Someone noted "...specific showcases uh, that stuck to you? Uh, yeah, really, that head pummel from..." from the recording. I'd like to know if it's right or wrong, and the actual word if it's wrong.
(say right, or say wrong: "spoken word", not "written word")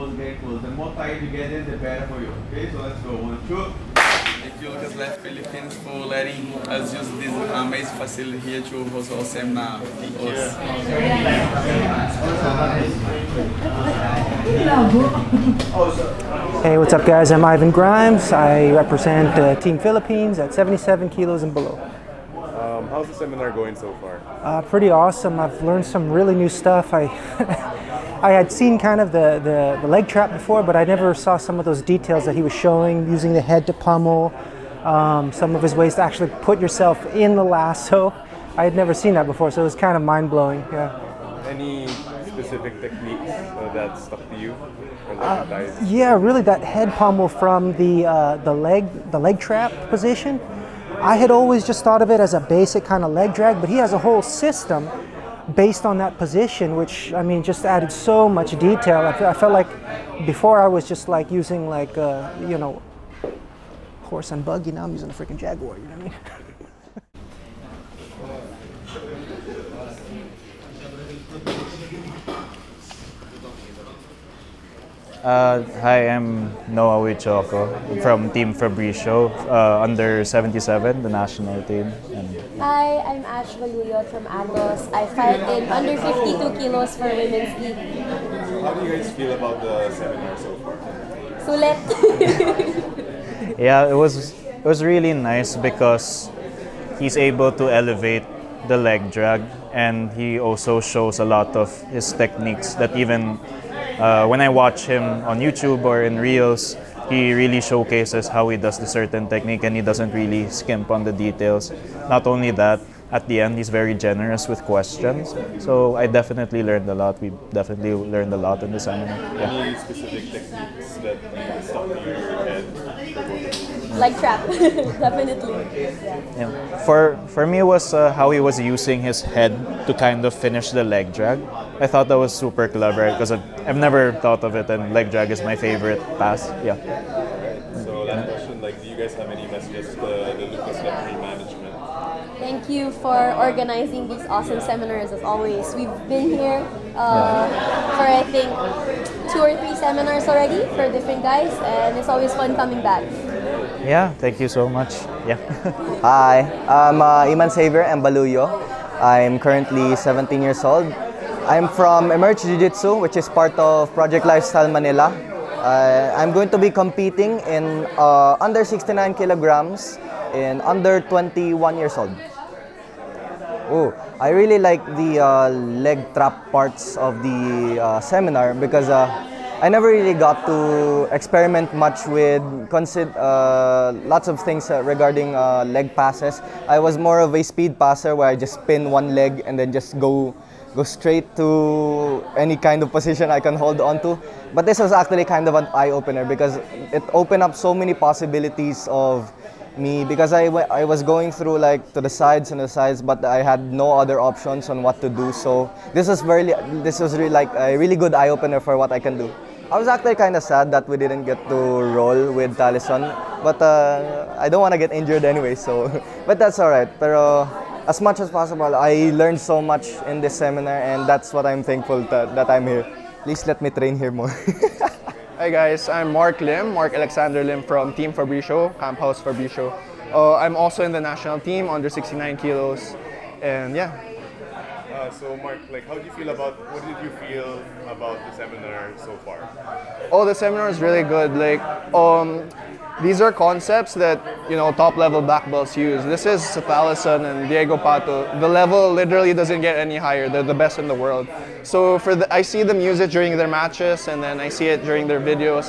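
wrong: "techniques", not "showcases".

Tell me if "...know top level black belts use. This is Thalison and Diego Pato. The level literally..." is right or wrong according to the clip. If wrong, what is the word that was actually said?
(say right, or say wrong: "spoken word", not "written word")
right.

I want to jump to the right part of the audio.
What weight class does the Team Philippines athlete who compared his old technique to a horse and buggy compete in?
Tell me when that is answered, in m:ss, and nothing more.
0:20.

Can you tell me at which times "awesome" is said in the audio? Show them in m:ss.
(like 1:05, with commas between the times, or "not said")
0:24, 2:24.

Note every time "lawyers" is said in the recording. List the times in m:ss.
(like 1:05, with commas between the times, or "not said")
not said.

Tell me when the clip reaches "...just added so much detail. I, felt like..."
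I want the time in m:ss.
0:57.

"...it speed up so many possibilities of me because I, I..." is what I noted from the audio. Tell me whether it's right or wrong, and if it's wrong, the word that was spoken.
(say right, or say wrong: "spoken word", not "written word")
wrong: "opened", not "speed".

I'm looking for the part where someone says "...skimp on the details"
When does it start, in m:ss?
1:50.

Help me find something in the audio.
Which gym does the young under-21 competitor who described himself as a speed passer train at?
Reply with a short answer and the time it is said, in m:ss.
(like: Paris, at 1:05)
Emerge Jiu-Jitsu, at 2:42.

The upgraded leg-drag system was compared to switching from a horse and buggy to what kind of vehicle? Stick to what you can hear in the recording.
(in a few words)
Jaguar.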